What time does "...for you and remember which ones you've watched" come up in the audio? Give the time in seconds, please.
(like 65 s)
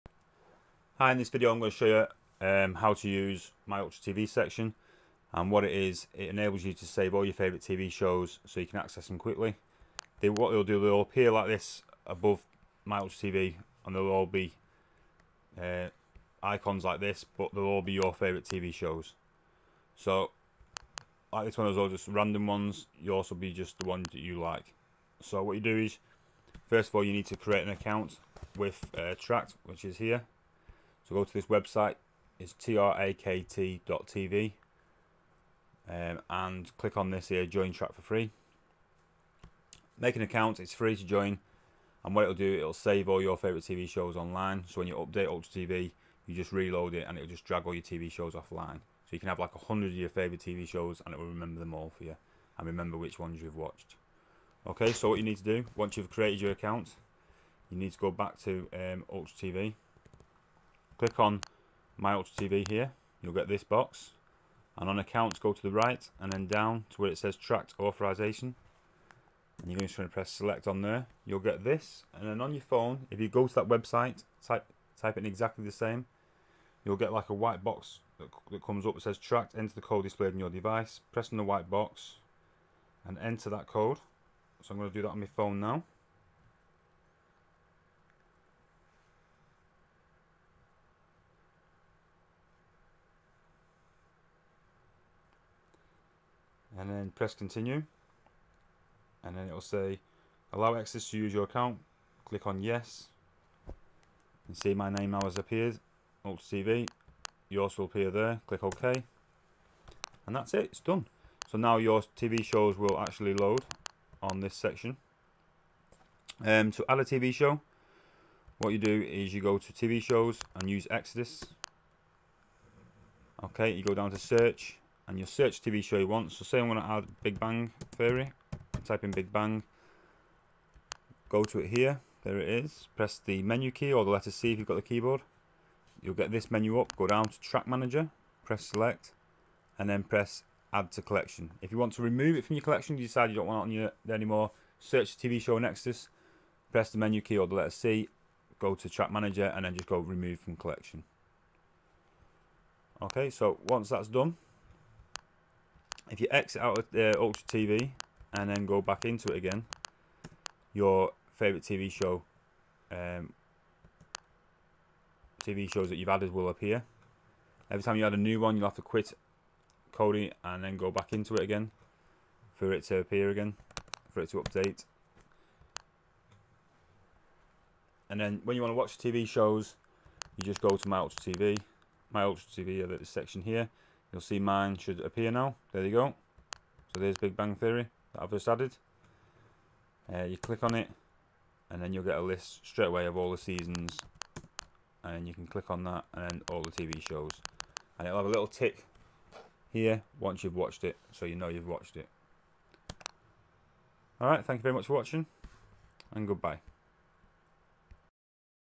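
51 s.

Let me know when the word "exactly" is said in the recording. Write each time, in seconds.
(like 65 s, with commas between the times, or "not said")
75 s.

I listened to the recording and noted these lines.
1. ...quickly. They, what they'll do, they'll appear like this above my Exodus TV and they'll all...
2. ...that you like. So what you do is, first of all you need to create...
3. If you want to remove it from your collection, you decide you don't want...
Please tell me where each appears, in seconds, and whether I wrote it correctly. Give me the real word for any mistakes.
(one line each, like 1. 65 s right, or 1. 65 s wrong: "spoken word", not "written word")
1. 9 s wrong: "Ultra", not "Exodus"
2. 24 s right
3. 141 s right.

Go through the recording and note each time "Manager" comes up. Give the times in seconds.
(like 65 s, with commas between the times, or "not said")
137 s, 149 s.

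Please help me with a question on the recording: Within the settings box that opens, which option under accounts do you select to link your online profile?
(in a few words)
Trakt authorization.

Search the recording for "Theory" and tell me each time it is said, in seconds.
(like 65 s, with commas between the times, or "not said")
127 s, 187 s.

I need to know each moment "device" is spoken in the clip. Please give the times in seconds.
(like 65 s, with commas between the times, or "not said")
80 s.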